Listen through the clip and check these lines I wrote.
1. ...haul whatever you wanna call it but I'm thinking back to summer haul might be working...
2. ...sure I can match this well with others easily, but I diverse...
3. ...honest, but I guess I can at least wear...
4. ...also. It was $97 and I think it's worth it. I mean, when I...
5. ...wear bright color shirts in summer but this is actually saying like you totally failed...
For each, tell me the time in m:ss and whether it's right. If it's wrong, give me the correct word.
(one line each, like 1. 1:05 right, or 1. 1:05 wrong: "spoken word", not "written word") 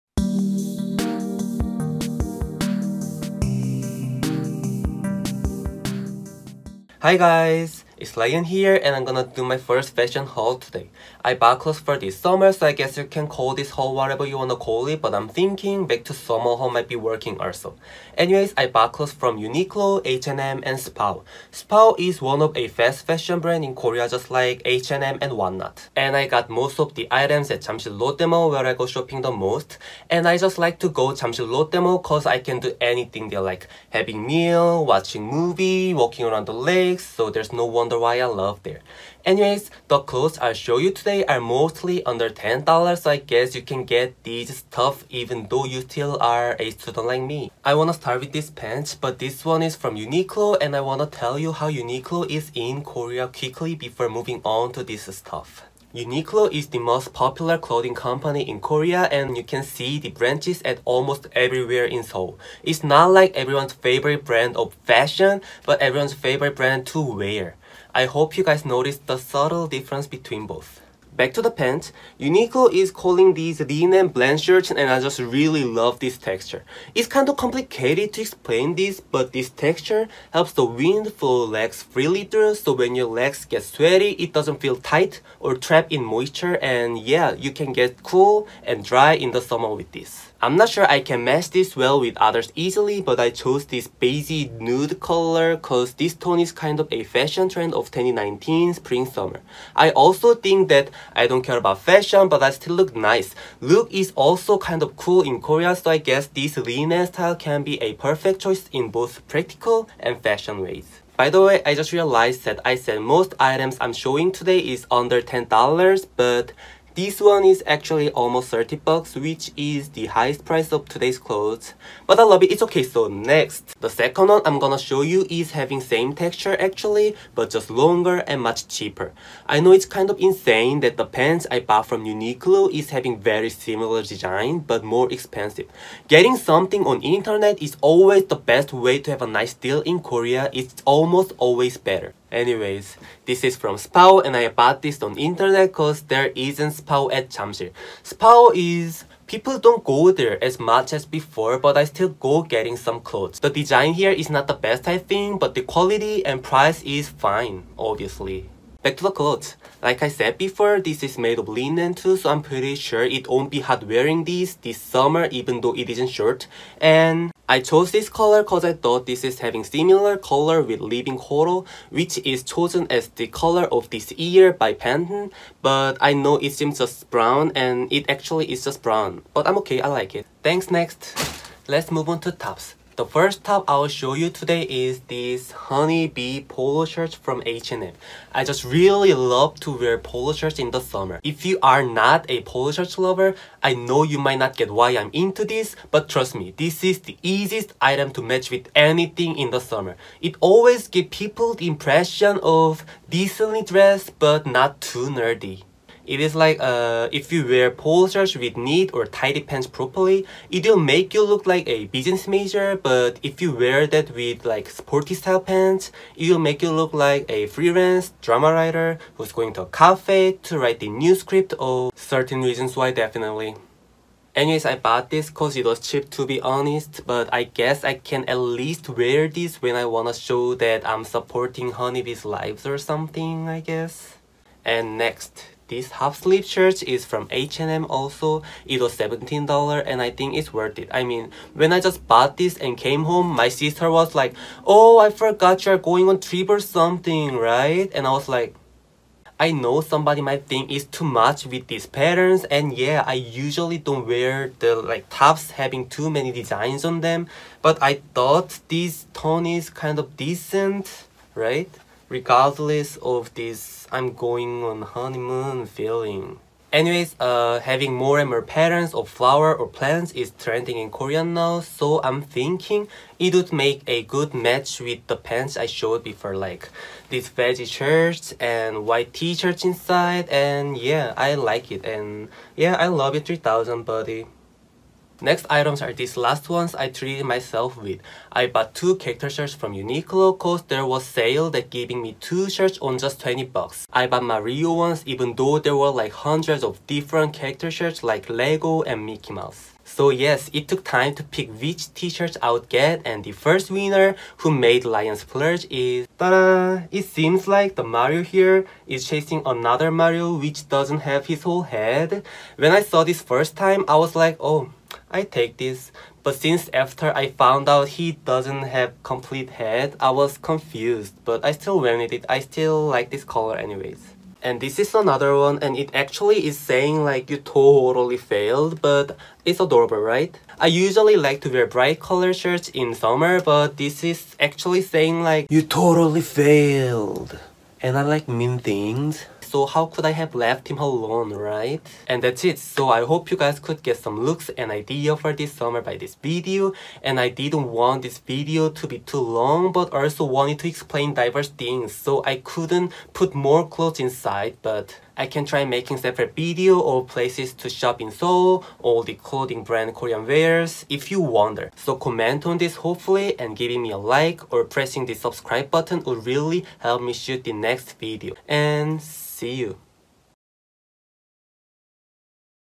1. 0:13 right
2. 1:30 wrong: "chose", not "diverse"
3. 3:46 right
4. 3:57 wrong: "17", not "97"
5. 5:31 right.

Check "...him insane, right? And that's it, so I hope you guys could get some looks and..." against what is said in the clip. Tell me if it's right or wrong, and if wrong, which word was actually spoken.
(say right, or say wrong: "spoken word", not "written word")
wrong: "alone", not "insane".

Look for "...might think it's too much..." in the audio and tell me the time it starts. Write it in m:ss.
4:10.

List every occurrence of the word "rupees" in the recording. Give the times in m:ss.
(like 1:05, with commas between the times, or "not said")
not said.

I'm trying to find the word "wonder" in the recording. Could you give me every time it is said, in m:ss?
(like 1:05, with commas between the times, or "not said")
0:37, 6:01.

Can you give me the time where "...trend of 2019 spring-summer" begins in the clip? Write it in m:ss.
1:37.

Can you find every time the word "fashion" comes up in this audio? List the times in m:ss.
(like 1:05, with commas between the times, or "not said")
0:09, 0:23, 1:04, 1:37, 1:41, 1:50.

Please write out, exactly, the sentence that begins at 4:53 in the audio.
I bought Mario ones even though there were like hundreds of different character shirts like Lego and Mickey Mouse.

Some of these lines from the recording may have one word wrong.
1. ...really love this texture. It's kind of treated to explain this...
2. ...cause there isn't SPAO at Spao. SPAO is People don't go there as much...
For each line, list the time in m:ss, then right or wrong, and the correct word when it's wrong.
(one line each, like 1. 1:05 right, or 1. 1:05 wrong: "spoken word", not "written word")
1. 1:15 wrong: "complicated", not "treated"
2. 2:25 wrong: "Jamsil", not "Spao".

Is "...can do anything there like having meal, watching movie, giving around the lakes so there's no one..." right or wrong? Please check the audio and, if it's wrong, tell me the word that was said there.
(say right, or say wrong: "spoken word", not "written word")
wrong: "walking", not "giving".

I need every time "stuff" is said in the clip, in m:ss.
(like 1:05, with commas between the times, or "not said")
0:44, 0:55.